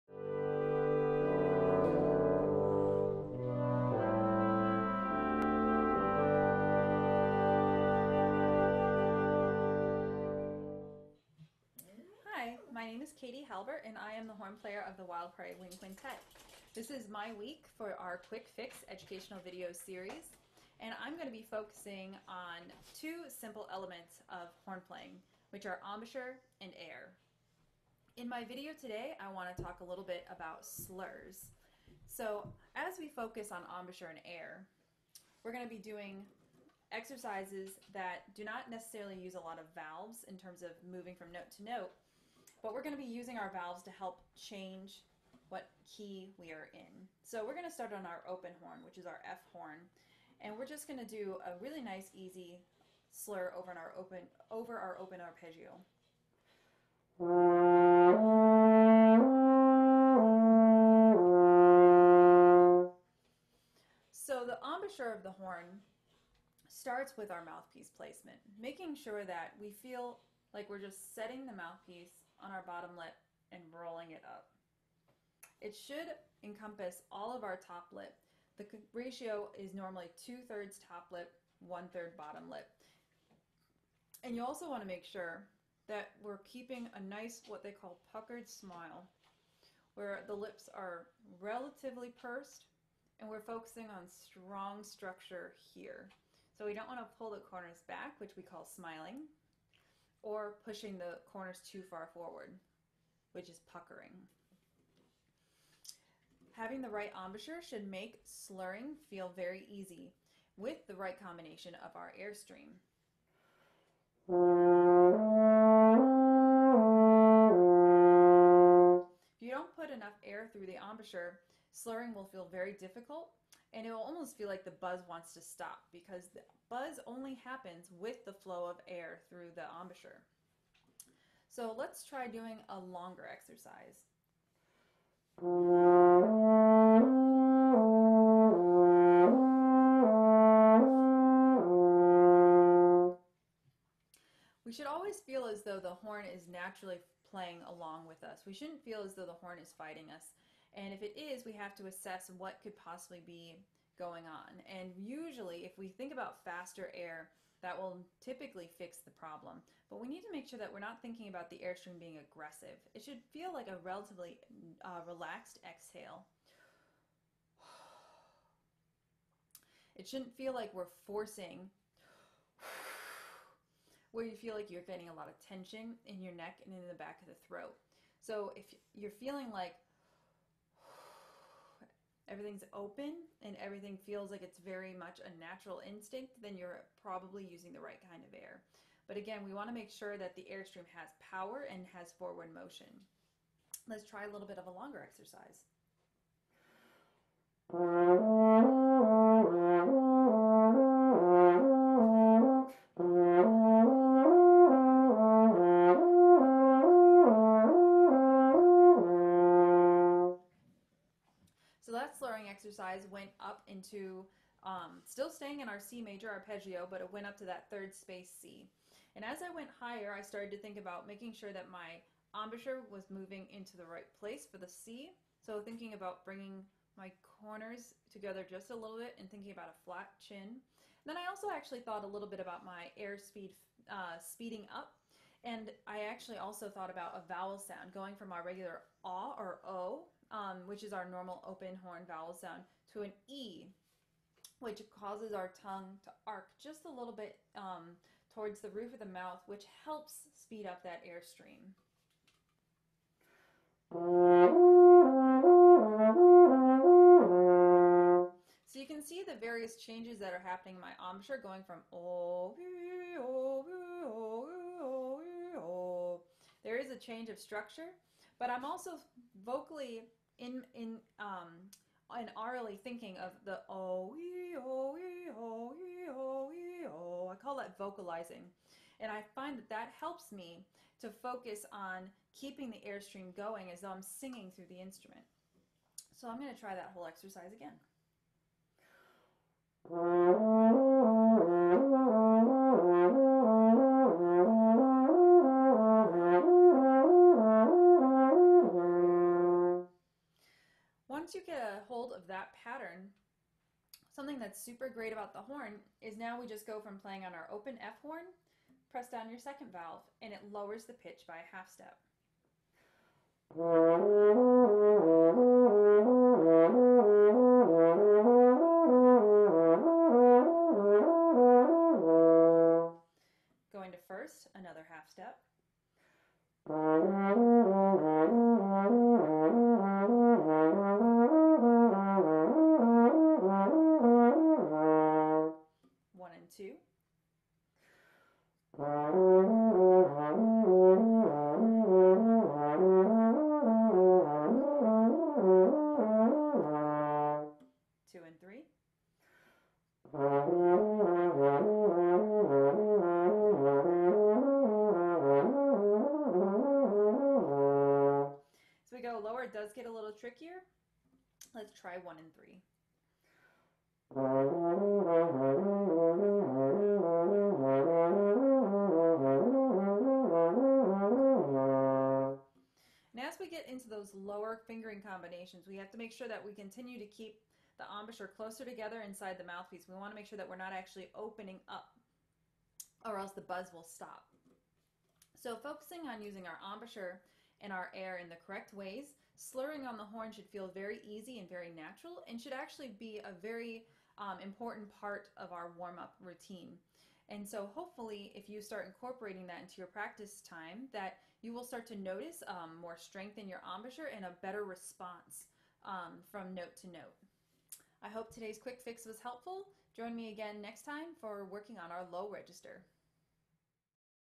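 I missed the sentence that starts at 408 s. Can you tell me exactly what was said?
I hope today's quick fix was helpful.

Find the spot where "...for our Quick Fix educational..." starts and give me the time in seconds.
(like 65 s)
17 s.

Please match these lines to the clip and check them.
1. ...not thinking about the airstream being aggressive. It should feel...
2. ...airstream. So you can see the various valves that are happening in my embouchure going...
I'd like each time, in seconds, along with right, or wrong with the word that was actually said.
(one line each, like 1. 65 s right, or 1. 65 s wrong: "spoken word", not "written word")
1. 160 s right
2. 251 s wrong: "changes", not "valves".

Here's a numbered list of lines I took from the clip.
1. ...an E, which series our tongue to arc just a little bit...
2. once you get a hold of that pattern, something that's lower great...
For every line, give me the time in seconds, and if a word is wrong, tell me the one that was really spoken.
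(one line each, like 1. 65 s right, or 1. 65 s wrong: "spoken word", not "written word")
1. 243 s wrong: "causes", not "series"
2. 301 s wrong: "super", not "lower".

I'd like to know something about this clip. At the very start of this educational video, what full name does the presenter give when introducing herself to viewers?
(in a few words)
Katey Halbert.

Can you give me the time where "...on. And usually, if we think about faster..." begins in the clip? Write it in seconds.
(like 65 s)
154 s.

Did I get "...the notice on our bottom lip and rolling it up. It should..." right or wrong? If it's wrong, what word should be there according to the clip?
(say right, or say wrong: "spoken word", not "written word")
wrong: "mouthpiece", not "notice".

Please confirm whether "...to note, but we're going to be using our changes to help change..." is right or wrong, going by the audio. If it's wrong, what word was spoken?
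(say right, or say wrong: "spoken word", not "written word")
wrong: "valves", not "changes".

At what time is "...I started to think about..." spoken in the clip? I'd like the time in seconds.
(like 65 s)
220 s.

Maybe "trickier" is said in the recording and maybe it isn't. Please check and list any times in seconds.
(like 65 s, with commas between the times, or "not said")
360 s.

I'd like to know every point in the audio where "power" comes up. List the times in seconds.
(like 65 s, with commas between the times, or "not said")
191 s.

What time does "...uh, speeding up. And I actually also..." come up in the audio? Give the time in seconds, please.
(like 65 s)
233 s.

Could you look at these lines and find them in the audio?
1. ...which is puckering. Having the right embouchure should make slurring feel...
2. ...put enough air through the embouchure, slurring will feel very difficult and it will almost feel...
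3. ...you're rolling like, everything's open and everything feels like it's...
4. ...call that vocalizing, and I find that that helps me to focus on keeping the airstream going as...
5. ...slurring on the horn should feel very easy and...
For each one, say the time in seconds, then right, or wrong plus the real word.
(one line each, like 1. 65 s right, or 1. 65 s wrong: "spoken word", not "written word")
1. 103 s right
2. 119 s right
3. 178 s wrong: "feeling", not "rolling"
4. 277 s right
5. 389 s right.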